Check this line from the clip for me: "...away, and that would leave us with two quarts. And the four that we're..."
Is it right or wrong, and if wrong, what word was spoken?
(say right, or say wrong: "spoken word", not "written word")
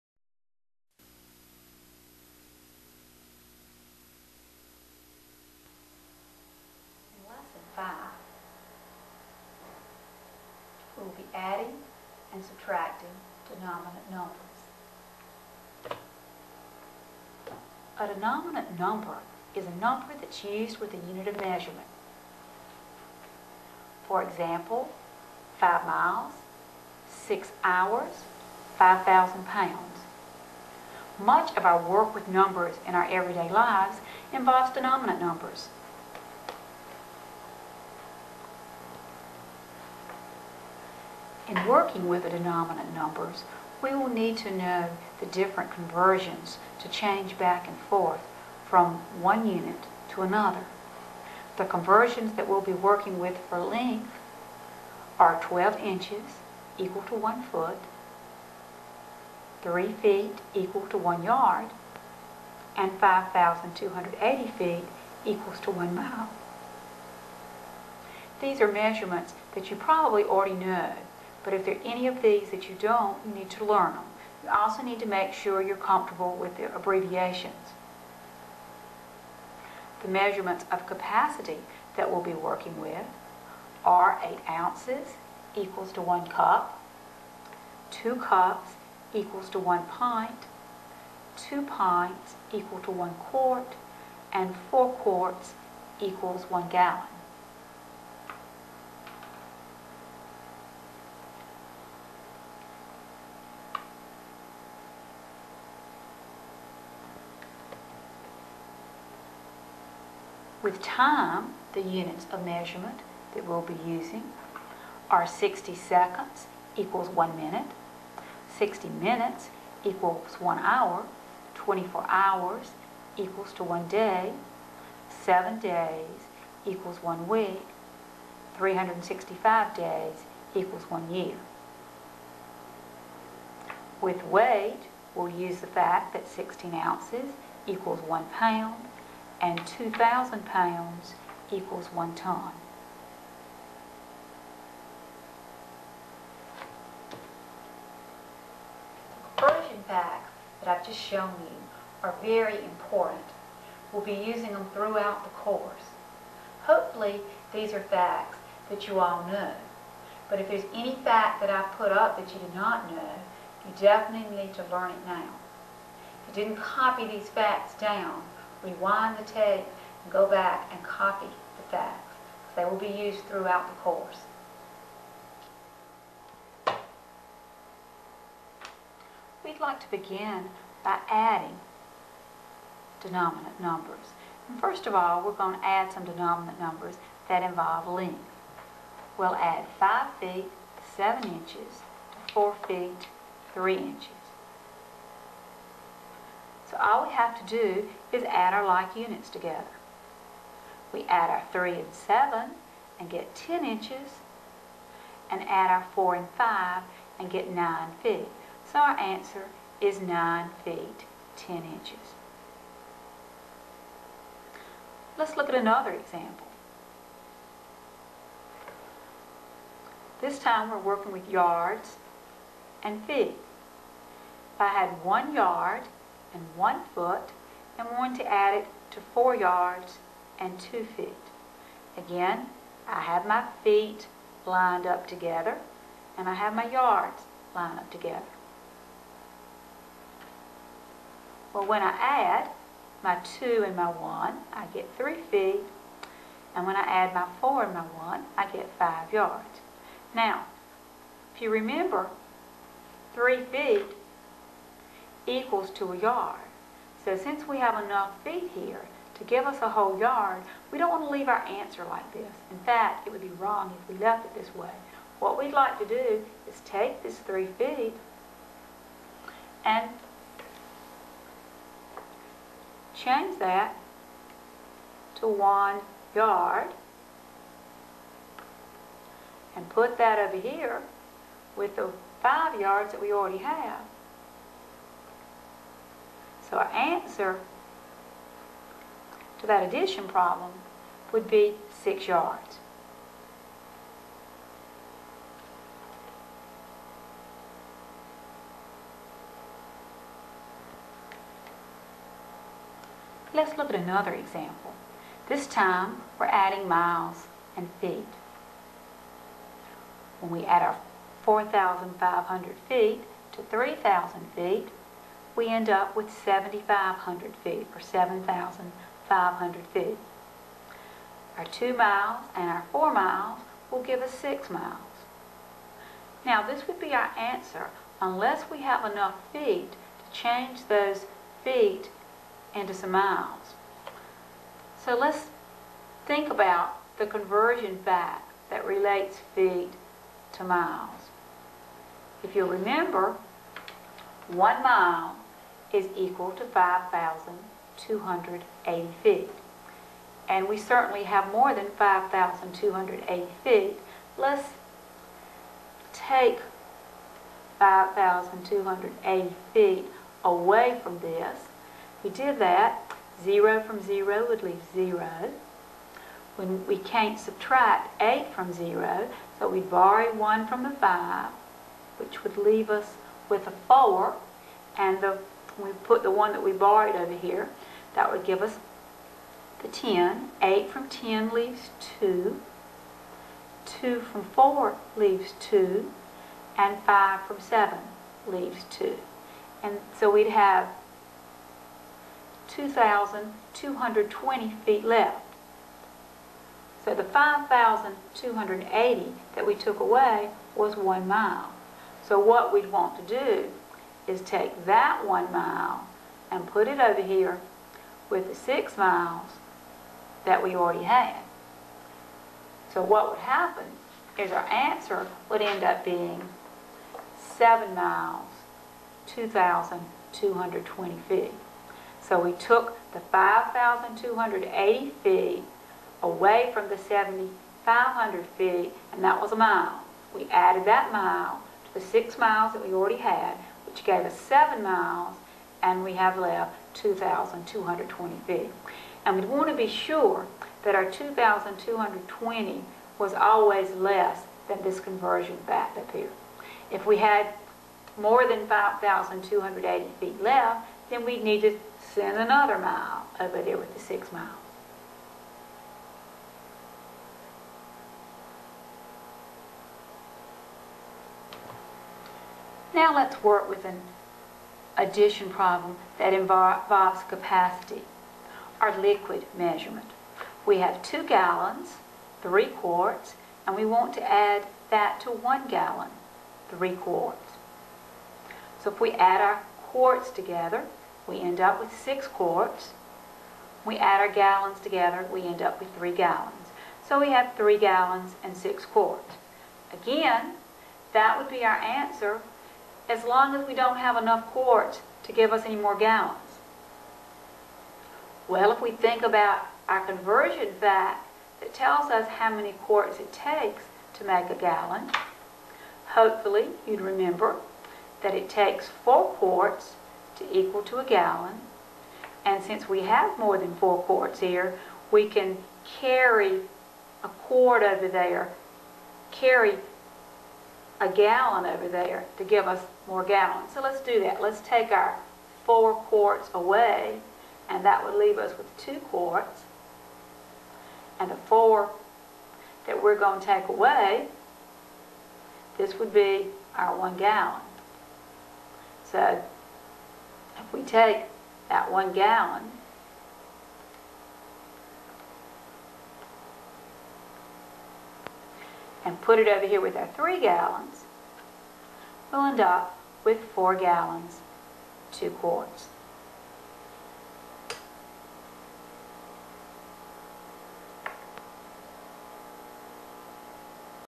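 right.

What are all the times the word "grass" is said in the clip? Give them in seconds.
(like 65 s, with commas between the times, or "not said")
not said.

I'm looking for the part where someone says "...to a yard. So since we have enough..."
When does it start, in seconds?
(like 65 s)
255 s.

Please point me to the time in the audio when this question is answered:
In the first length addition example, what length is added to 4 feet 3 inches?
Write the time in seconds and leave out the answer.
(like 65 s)
189 s.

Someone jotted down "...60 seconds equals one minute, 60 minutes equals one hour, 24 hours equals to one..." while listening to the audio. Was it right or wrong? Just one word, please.
right.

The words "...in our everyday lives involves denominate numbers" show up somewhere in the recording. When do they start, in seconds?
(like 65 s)
32 s.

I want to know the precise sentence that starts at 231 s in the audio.
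Again, I have my feet lined up together and I have my yards lined up together.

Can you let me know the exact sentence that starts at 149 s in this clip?
Conversion facts that I've just shown you are very important.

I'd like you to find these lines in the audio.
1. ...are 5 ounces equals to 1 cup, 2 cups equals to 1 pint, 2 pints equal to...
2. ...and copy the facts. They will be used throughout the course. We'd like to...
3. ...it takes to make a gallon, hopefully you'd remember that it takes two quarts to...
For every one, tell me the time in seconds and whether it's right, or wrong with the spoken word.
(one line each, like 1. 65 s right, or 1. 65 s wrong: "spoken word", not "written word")
1. 83 s wrong: "8", not "5"
2. 170 s right
3. 502 s wrong: "four", not "two".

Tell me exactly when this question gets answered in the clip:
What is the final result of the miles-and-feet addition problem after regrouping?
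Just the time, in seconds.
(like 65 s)
417 s.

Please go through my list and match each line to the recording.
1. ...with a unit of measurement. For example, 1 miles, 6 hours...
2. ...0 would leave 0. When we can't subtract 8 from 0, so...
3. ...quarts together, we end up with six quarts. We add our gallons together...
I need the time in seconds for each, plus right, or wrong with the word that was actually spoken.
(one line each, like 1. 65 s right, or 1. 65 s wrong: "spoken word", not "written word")
1. 20 s wrong: "5", not "1"
2. 363 s right
3. 479 s right.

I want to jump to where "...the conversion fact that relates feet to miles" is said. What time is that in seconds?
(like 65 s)
336 s.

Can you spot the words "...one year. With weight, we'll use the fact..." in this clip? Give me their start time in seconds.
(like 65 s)
130 s.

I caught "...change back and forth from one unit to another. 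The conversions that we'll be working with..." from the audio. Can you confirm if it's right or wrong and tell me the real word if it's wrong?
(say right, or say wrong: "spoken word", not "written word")
right.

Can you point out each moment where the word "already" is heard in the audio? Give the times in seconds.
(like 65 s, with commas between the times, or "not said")
70 s, 283 s, 410 s, 432 s.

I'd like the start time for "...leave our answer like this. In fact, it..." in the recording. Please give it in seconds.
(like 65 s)
261 s.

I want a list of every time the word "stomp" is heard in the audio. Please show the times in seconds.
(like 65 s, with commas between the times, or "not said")
not said.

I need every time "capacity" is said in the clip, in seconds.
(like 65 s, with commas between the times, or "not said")
80 s, 467 s.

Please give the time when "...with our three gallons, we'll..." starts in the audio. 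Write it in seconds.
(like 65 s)
549 s.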